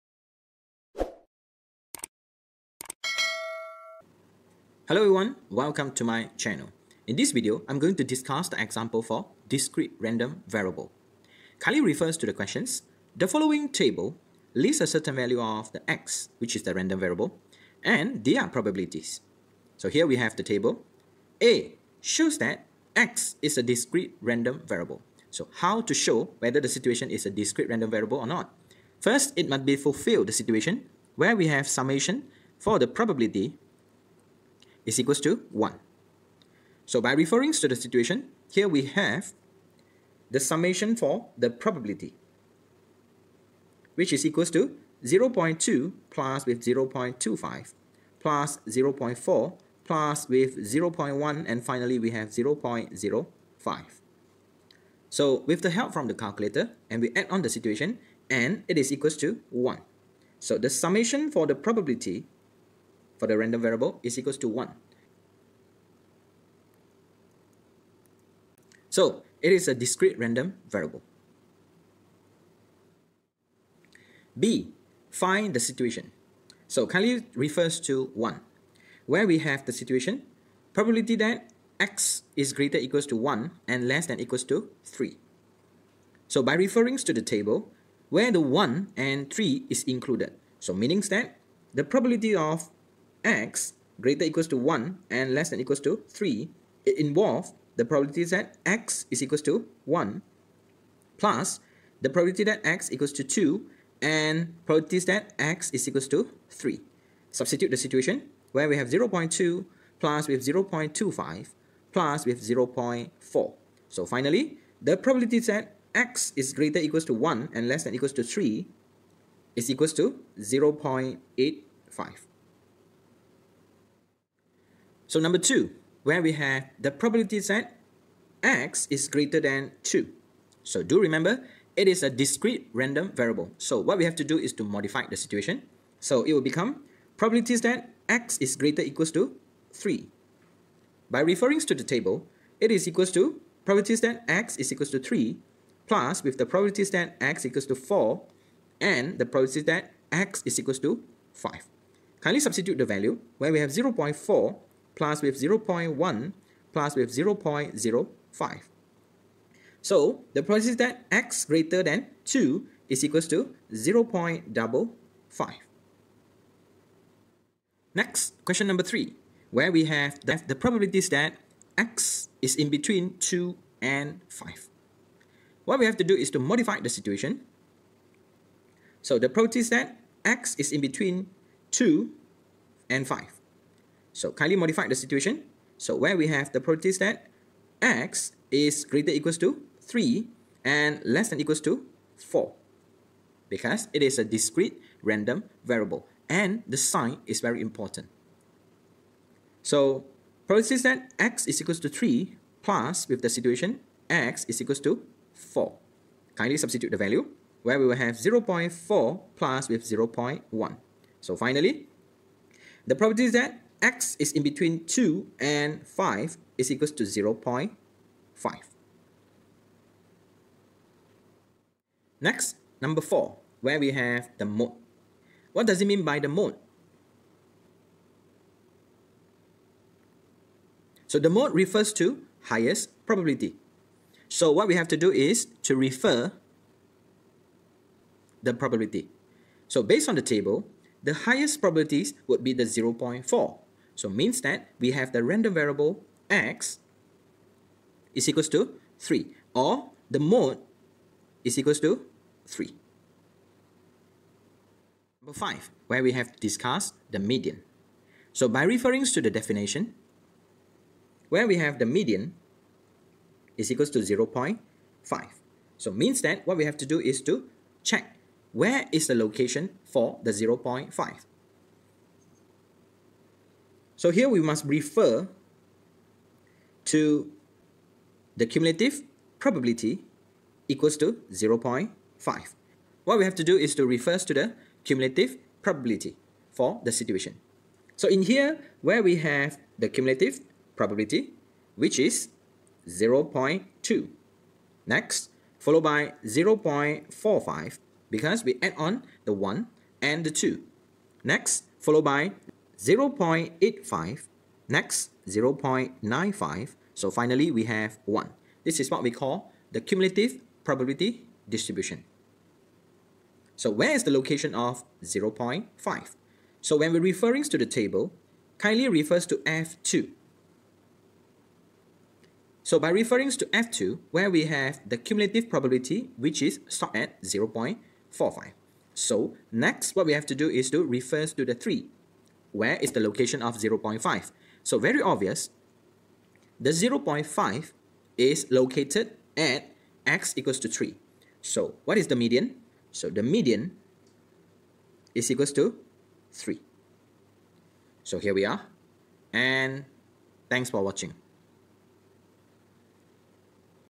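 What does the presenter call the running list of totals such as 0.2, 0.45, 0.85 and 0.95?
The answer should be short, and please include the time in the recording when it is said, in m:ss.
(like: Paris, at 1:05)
cumulative probability distribution, at 5:09.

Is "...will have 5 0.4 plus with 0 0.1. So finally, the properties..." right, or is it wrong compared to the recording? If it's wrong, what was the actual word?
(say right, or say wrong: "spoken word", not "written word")
wrong: "0", not "5".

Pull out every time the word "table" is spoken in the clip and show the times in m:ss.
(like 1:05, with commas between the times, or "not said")
0:13, 0:20, 1:27, 2:21, 4:00, 5:17.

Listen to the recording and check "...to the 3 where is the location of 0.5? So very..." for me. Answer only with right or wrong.
right.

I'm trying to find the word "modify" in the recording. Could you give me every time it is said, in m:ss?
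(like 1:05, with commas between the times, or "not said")
2:14, 2:56, 3:04.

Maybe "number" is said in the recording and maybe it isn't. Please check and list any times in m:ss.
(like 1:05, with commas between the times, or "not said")
2:05, 2:48, 3:42, 4:15.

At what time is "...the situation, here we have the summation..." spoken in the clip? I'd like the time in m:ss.
0:37.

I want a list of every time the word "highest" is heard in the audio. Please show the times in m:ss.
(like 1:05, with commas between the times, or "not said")
3:52, 4:01.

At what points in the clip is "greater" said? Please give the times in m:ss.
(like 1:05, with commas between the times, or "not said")
1:22, 1:33, 1:56, 2:09, 2:18, 2:41, 3:08.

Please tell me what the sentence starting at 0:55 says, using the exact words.
So with the help from the calculator and we add on the situation and it is equals to 1.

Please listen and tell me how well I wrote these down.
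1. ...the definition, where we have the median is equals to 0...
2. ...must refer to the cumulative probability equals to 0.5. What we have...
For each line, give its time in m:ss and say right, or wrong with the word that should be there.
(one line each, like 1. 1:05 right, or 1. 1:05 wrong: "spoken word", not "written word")
1. 4:19 right
2. 4:34 right.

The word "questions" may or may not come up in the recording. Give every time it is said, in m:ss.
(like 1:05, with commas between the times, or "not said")
0:12, 2:48.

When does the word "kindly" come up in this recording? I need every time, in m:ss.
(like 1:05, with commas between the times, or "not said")
1:16, 2:32, 3:04, 3:26, 5:18.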